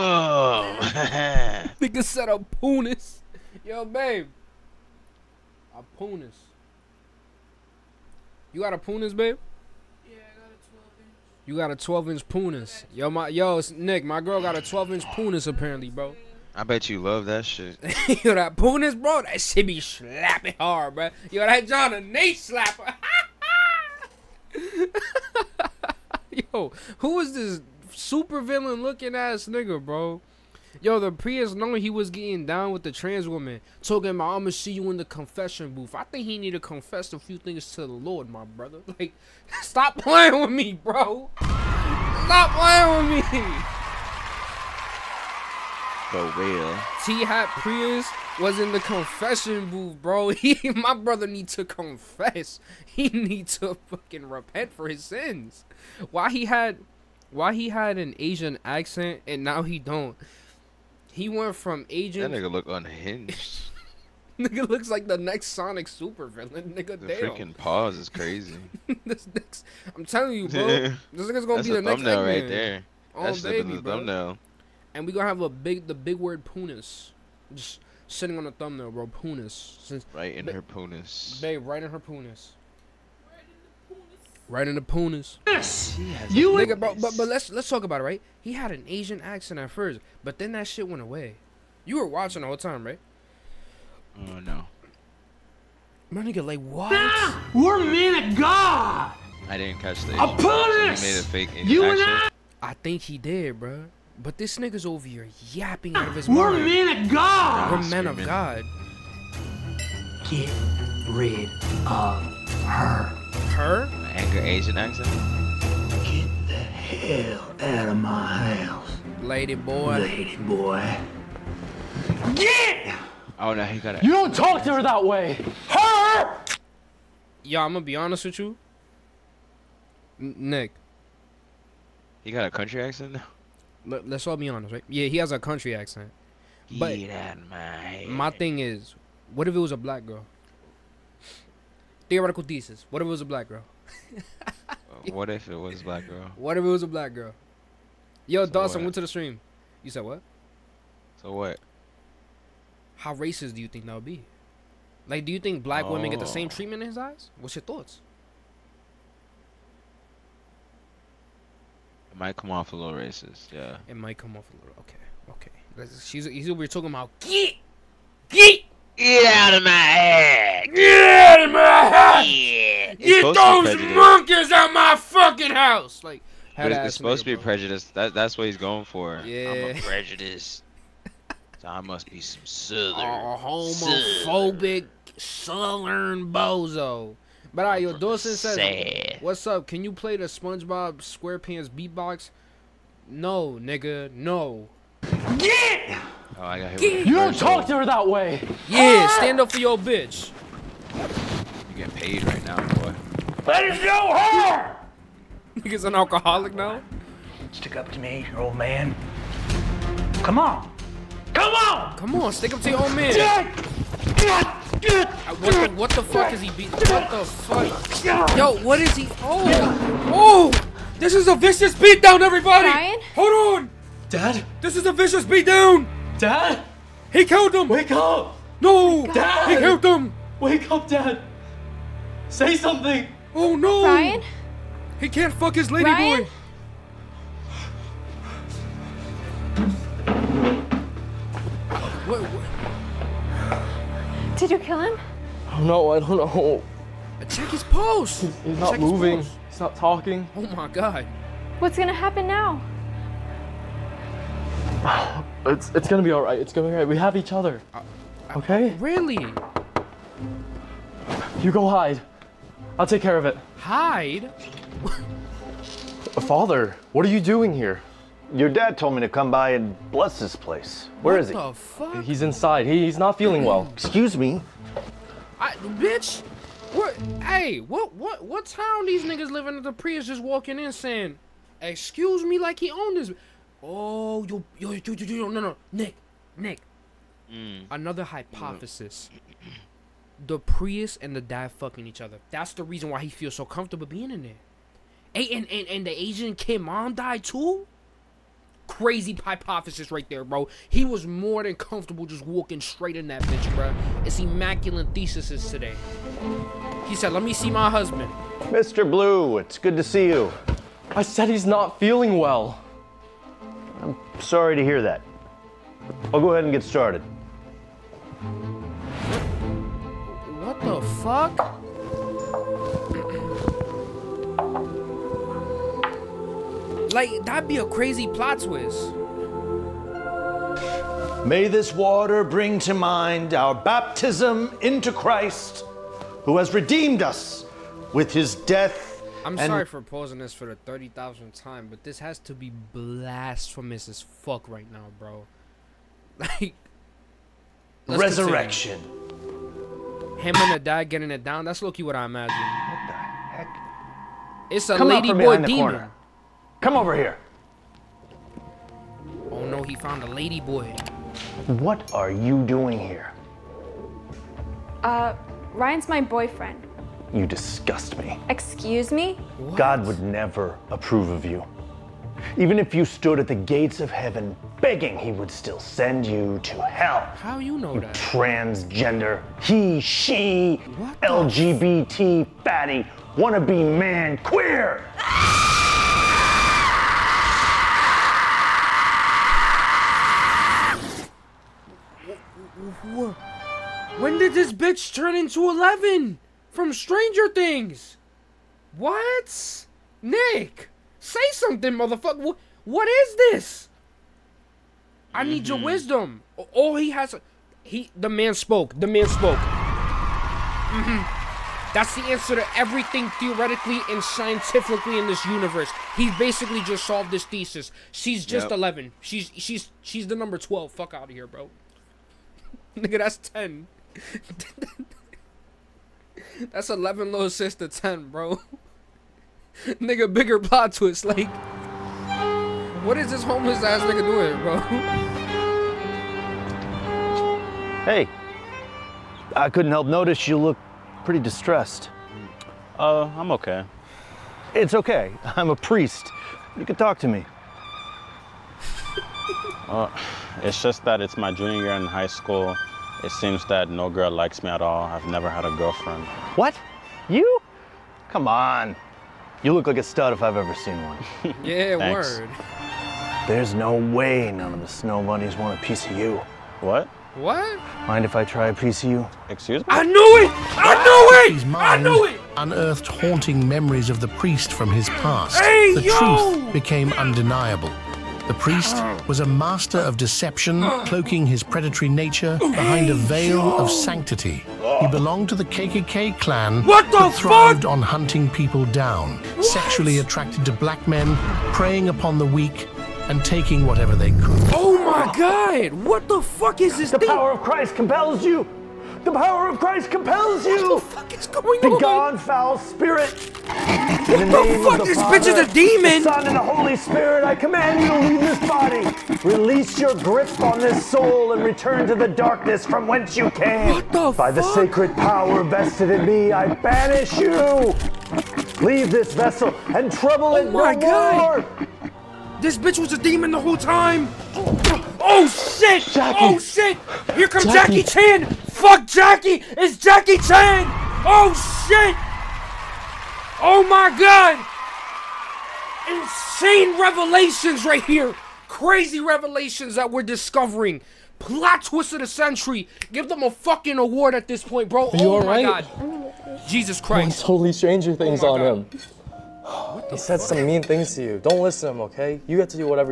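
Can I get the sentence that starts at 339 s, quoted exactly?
I'm sorry for pausing this for the 30,000th time, but this has to be blasphemous as fuck right now, bro.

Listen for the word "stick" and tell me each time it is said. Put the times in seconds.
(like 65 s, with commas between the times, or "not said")
207 s, 212 s.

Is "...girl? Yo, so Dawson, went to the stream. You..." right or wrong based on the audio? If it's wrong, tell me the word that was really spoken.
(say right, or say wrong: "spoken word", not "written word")
right.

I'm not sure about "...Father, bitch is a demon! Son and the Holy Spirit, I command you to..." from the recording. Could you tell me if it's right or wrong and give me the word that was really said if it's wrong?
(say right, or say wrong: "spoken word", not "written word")
right.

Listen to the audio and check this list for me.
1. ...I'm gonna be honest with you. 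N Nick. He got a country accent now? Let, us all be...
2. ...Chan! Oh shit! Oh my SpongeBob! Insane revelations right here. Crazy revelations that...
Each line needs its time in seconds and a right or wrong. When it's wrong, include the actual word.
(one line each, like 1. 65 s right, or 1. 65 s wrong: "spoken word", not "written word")
1. 127 s right
2. 530 s wrong: "God", not "SpongeBob".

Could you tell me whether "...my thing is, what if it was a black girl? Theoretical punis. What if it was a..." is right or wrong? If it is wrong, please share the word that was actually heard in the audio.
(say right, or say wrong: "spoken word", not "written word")
wrong: "thesis", not "punis".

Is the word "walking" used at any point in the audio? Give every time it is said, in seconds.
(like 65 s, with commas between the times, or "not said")
280 s, 302 s.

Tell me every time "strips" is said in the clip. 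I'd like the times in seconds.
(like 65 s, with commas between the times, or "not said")
not said.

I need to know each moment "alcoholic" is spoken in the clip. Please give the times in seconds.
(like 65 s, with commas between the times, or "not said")
205 s.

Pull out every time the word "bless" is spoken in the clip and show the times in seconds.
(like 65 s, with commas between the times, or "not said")
269 s.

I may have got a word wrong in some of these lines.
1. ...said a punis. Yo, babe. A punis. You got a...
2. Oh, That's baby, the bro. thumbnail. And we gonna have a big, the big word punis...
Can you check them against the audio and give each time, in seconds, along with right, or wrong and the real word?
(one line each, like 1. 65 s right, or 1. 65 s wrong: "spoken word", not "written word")
1. 2 s right
2. 73 s right.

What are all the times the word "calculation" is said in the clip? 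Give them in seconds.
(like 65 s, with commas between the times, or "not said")
not said.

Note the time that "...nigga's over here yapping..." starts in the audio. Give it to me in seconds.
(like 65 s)
104 s.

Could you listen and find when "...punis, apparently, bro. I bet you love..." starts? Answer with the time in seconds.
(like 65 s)
15 s.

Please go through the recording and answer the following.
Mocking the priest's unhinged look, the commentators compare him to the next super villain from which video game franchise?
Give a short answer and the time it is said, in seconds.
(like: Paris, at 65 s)
Sonic, at 65 s.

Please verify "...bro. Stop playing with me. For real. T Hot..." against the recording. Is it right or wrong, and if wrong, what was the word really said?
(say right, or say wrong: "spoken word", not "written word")
right.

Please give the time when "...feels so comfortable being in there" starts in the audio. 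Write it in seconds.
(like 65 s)
293 s.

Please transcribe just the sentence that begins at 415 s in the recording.
He basically just solved this thesis.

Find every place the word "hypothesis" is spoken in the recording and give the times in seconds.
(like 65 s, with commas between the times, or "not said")
288 s, 299 s.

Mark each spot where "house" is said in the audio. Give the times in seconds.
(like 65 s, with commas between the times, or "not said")
118 s, 175 s.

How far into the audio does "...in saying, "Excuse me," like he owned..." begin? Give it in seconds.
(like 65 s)
280 s.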